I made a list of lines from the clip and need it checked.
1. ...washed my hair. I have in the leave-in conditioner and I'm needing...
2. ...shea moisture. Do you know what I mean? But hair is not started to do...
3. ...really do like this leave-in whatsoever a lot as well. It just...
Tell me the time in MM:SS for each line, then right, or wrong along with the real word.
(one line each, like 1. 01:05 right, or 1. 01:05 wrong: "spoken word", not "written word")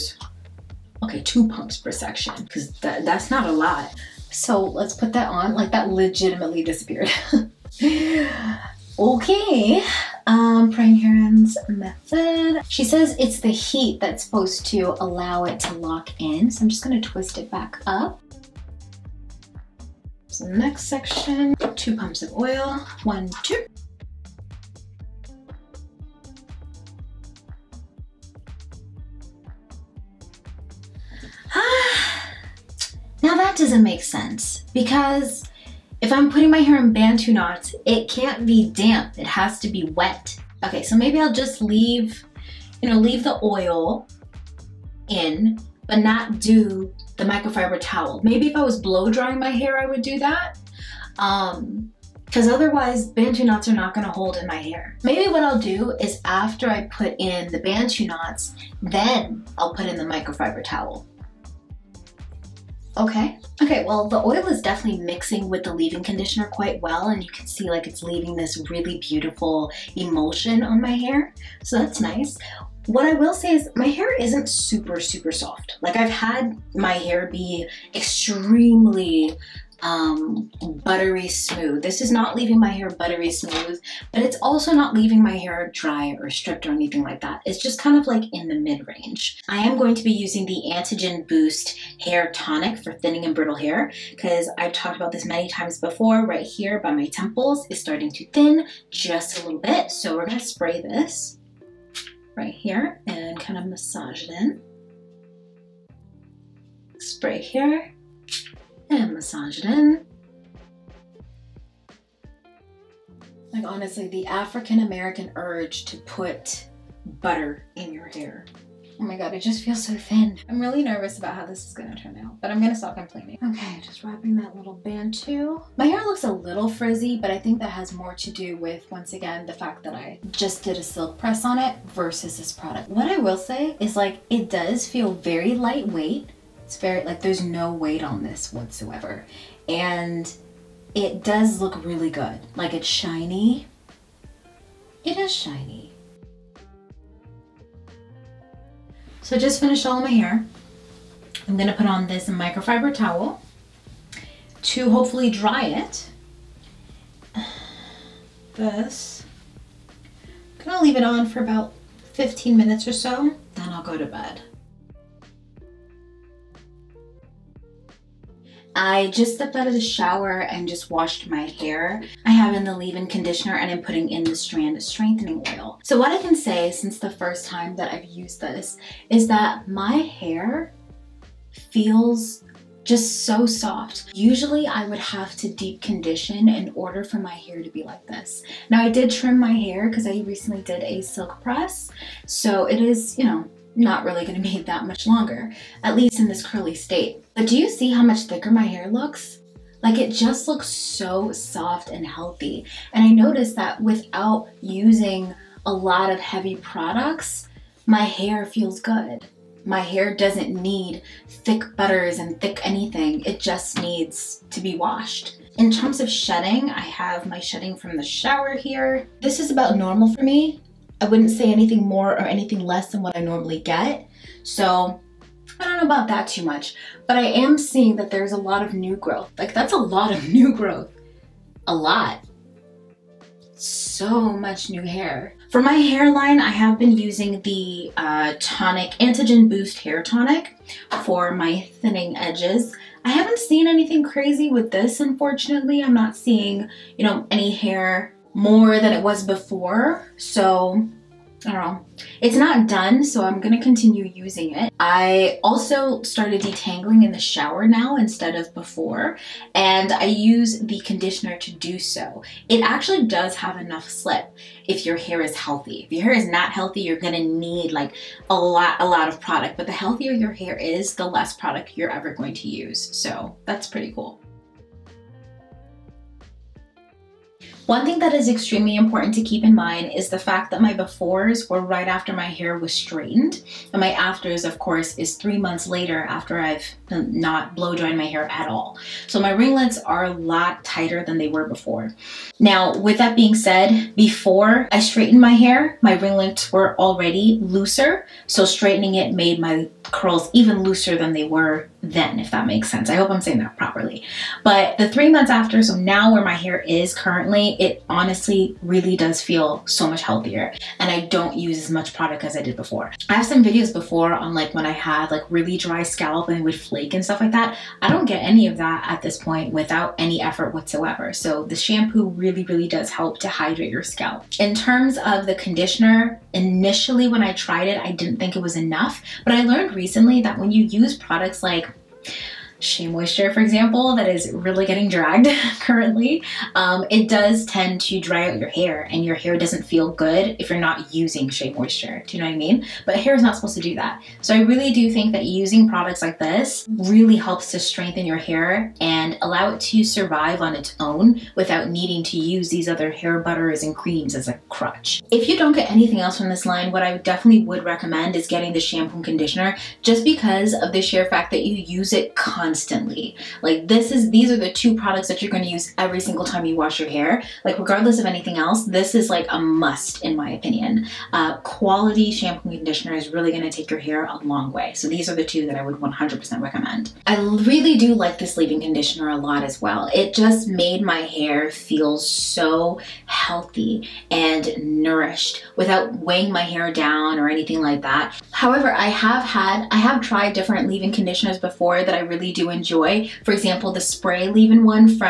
1. 02:50 wrong: "putting", not "needing"
2. 05:41 wrong: "supposed", not "started"
3. 06:17 wrong: "conditioner", not "whatsoever".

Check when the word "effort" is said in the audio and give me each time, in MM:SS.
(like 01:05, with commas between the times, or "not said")
05:20.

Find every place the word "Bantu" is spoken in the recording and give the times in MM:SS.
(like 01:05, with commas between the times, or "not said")
00:36, 00:53, 00:57, 02:04.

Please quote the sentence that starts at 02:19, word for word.
And it does look really good.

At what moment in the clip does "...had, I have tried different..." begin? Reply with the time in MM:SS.
06:29.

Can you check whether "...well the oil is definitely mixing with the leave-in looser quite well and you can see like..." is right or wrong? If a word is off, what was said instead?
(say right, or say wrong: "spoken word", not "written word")
wrong: "conditioner", not "looser".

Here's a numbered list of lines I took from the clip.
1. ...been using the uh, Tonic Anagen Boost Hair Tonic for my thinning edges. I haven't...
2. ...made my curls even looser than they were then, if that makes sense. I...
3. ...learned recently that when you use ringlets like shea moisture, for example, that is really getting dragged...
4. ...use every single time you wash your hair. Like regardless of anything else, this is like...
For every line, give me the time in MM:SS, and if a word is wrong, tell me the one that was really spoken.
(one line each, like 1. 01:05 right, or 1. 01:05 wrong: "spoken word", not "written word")
1. 03:56 right
2. 04:59 right
3. 05:29 wrong: "products", not "ringlets"
4. 06:05 right.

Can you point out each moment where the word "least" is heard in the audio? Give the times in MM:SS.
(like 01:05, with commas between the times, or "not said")
03:15.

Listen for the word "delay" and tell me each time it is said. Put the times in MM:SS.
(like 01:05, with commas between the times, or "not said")
not said.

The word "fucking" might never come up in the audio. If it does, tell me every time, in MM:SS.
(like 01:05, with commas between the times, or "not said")
not said.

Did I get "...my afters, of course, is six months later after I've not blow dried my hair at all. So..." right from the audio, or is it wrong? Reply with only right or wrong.
wrong.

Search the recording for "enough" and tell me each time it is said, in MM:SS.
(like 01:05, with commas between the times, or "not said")
04:23, 05:28.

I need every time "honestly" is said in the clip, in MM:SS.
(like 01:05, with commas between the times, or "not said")
01:53, 05:07.